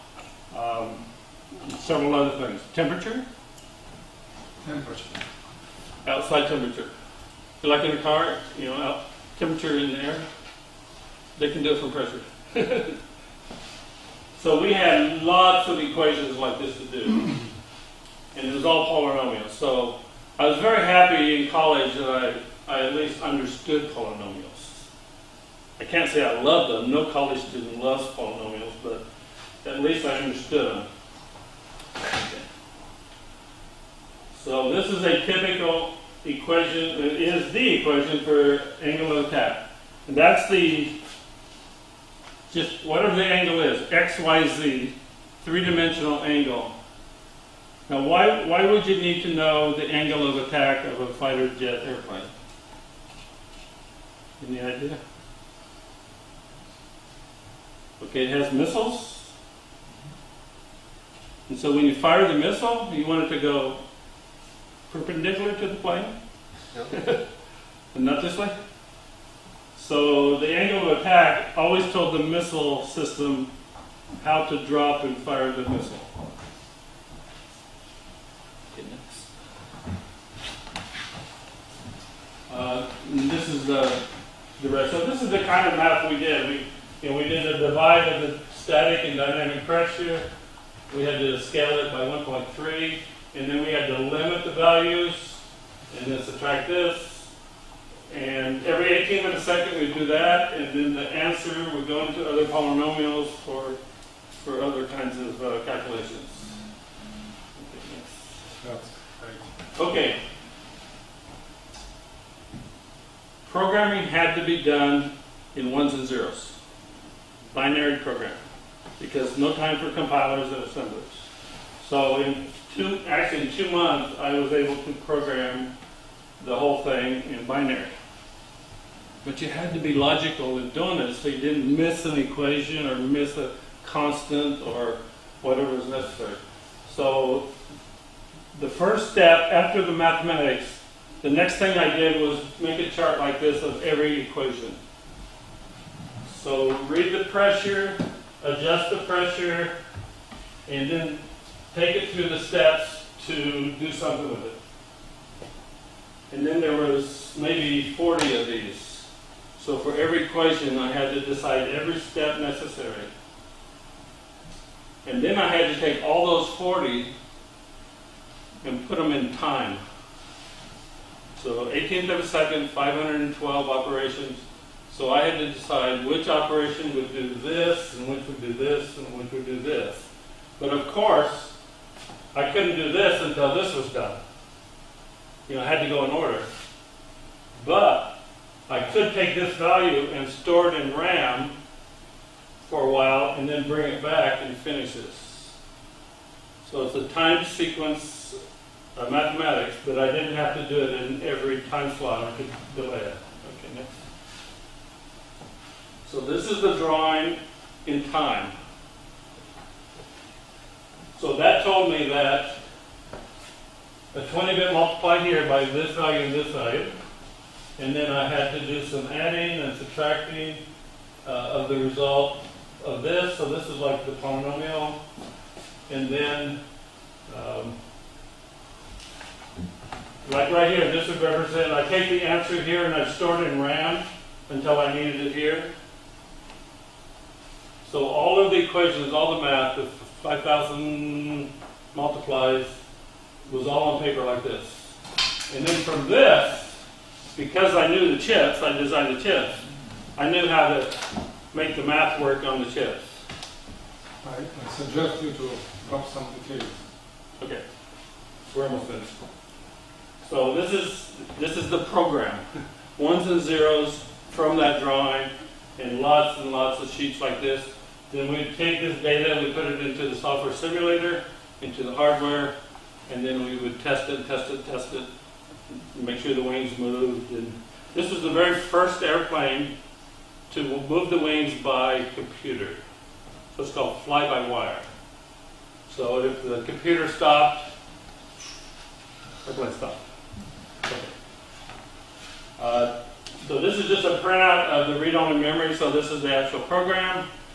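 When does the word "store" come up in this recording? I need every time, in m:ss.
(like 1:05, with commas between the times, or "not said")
3:10, 3:53.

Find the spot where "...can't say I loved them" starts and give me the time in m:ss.
0:25.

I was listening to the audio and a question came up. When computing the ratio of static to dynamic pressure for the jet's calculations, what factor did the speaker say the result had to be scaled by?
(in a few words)
1.3.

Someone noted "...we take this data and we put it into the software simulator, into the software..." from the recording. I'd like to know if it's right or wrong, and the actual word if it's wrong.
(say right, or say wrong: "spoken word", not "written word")
wrong: "hardware", not "software".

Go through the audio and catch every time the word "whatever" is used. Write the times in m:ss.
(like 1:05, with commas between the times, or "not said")
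0:42, 2:15.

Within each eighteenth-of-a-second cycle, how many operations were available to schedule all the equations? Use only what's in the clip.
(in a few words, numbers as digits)
512.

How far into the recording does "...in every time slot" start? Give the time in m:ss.
3:21.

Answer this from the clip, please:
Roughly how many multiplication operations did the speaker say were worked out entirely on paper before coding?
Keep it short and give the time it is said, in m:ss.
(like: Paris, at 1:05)
5,000, at 4:00.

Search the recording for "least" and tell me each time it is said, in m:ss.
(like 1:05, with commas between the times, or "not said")
0:22, 0:29.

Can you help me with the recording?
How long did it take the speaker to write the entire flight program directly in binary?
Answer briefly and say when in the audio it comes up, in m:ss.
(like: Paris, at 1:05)
2 months, at 2:03.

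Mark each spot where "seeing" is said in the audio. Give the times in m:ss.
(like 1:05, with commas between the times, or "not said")
not said.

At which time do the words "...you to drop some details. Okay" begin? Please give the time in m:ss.
4:15.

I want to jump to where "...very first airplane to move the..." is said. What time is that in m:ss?
4:38.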